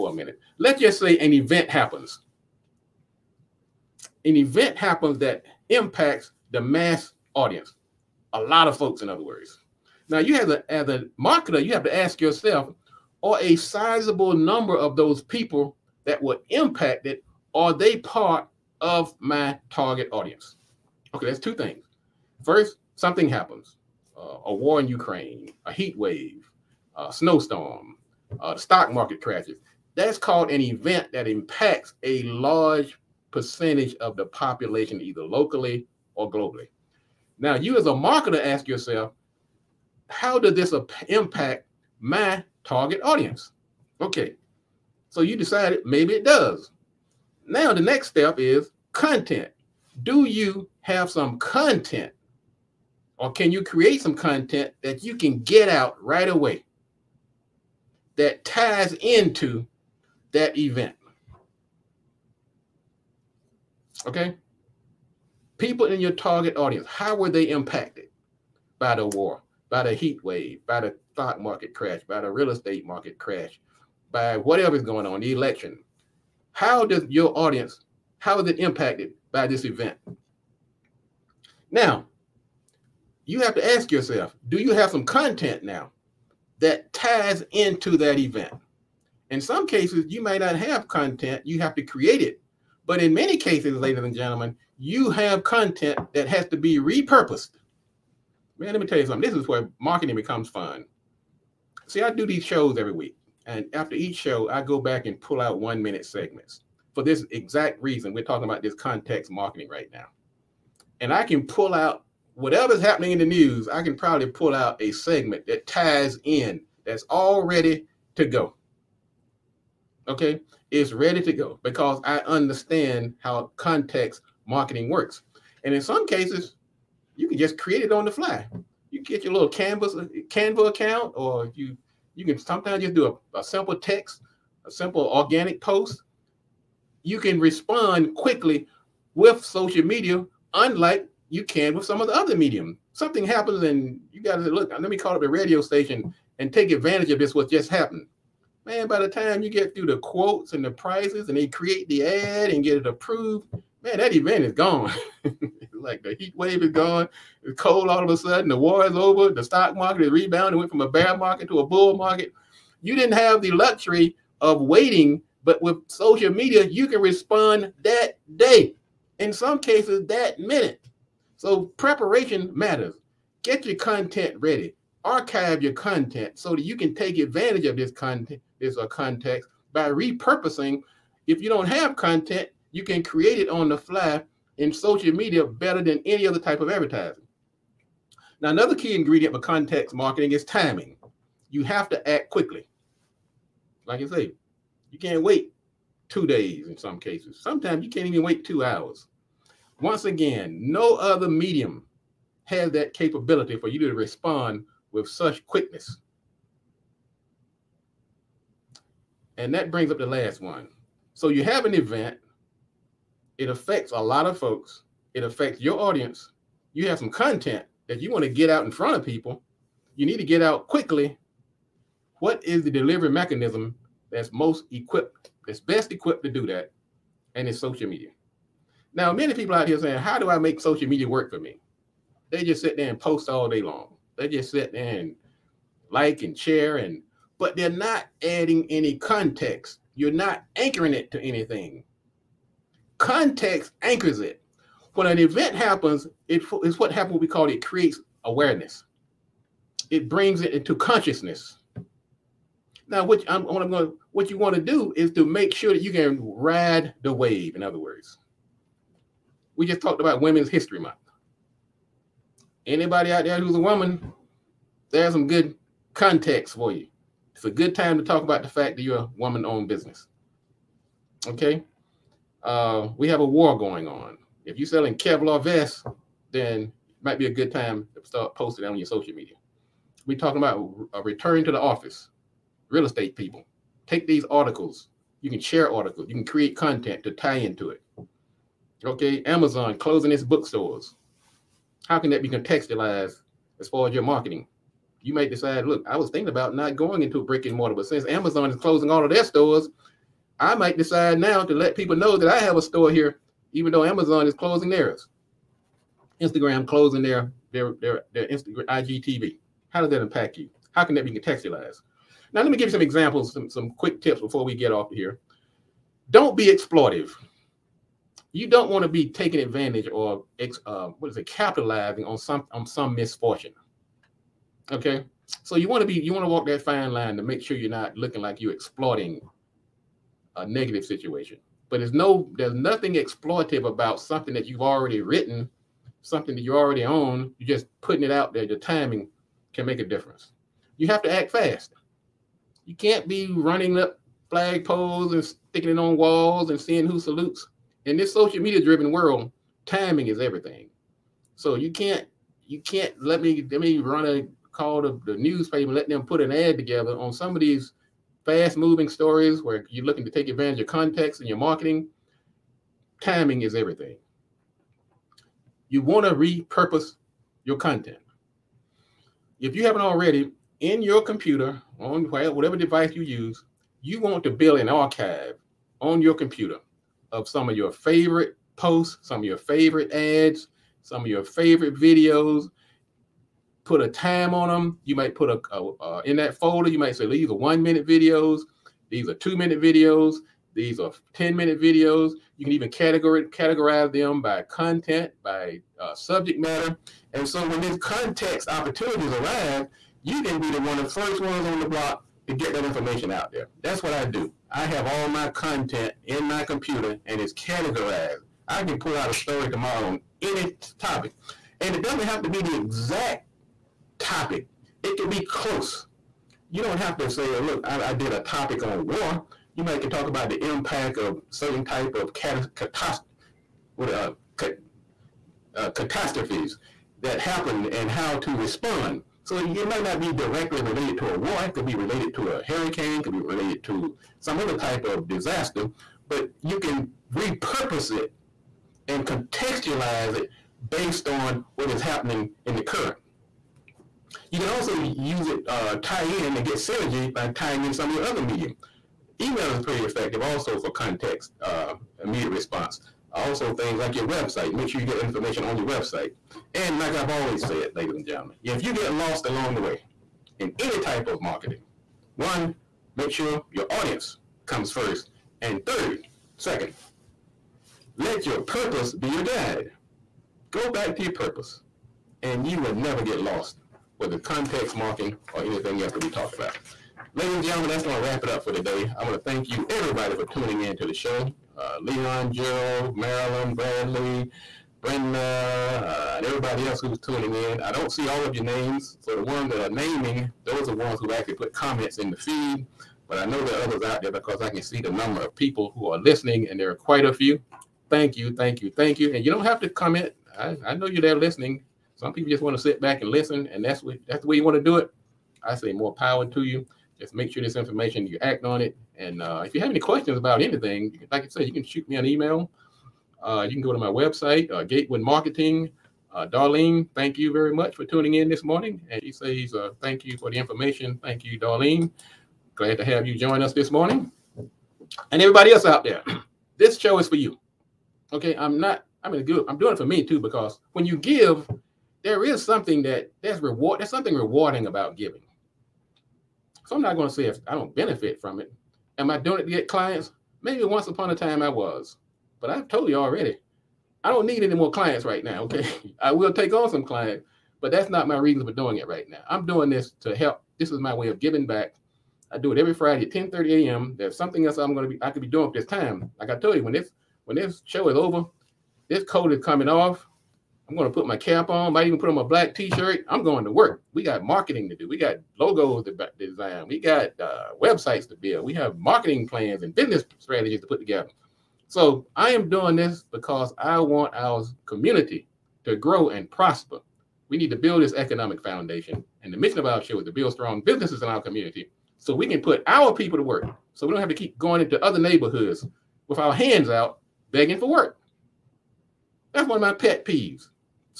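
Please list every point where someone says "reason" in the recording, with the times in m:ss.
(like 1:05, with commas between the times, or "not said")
1:47, 9:08.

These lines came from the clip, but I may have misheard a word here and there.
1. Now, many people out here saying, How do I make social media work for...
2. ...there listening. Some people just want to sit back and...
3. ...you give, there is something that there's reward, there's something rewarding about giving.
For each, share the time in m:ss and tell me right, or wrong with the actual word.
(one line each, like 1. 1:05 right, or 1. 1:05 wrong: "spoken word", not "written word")
1. 3:48 right
2. 8:21 right
3. 8:50 right.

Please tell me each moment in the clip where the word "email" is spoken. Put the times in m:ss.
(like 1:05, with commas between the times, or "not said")
7:29, 8:32.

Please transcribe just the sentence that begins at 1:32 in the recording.
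But in many cases, ladies and gentlemen, you have content that has to be repurposed.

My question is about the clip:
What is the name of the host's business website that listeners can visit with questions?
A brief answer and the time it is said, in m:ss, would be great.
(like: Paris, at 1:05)
Gatewood Marketing, at 8:34.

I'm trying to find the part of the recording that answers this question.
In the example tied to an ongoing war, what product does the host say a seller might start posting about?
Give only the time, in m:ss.
4:34.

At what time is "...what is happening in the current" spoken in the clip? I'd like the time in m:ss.
7:21.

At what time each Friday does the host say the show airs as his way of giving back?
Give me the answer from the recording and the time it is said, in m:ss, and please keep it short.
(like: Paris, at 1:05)
10:30 a.m., at 9:13.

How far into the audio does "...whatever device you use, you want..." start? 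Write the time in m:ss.
6:12.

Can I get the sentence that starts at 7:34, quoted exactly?
Make sure you get information on your website.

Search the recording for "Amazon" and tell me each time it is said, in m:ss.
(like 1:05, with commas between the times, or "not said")
4:49, 4:58, 5:03.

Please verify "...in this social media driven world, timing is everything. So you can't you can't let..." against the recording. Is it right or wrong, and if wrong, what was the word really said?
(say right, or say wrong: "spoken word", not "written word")
right.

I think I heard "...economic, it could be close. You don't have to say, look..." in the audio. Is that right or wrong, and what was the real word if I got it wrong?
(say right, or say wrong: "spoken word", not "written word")
wrong: "topic", not "economic".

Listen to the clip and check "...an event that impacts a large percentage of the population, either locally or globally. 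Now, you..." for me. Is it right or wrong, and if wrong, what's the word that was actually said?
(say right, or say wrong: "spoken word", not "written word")
right.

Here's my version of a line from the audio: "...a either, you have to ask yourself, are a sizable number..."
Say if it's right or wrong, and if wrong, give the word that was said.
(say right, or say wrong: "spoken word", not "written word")
wrong: "marketer", not "either".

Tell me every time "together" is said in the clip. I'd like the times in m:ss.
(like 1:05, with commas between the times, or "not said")
5:56, 9:30.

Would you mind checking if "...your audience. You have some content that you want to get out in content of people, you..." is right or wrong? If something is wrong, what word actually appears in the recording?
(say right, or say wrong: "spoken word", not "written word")
wrong: "front", not "content".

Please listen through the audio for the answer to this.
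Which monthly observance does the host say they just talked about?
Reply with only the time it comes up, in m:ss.
4:20.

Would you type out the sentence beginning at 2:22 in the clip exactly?
Something happens and you got to look, let me call up the radio station and take advantage of this, what just happened.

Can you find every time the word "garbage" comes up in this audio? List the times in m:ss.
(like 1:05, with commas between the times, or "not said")
not said.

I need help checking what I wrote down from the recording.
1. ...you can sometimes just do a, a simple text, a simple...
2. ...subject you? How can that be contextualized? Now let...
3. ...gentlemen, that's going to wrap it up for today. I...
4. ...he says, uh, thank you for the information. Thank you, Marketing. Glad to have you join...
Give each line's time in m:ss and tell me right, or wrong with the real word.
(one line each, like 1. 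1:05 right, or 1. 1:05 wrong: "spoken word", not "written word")
1. 2:12 right
2. 5:10 wrong: "impact", not "subject"
3. 7:57 right
4. 8:39 wrong: "Darlene", not "Marketing".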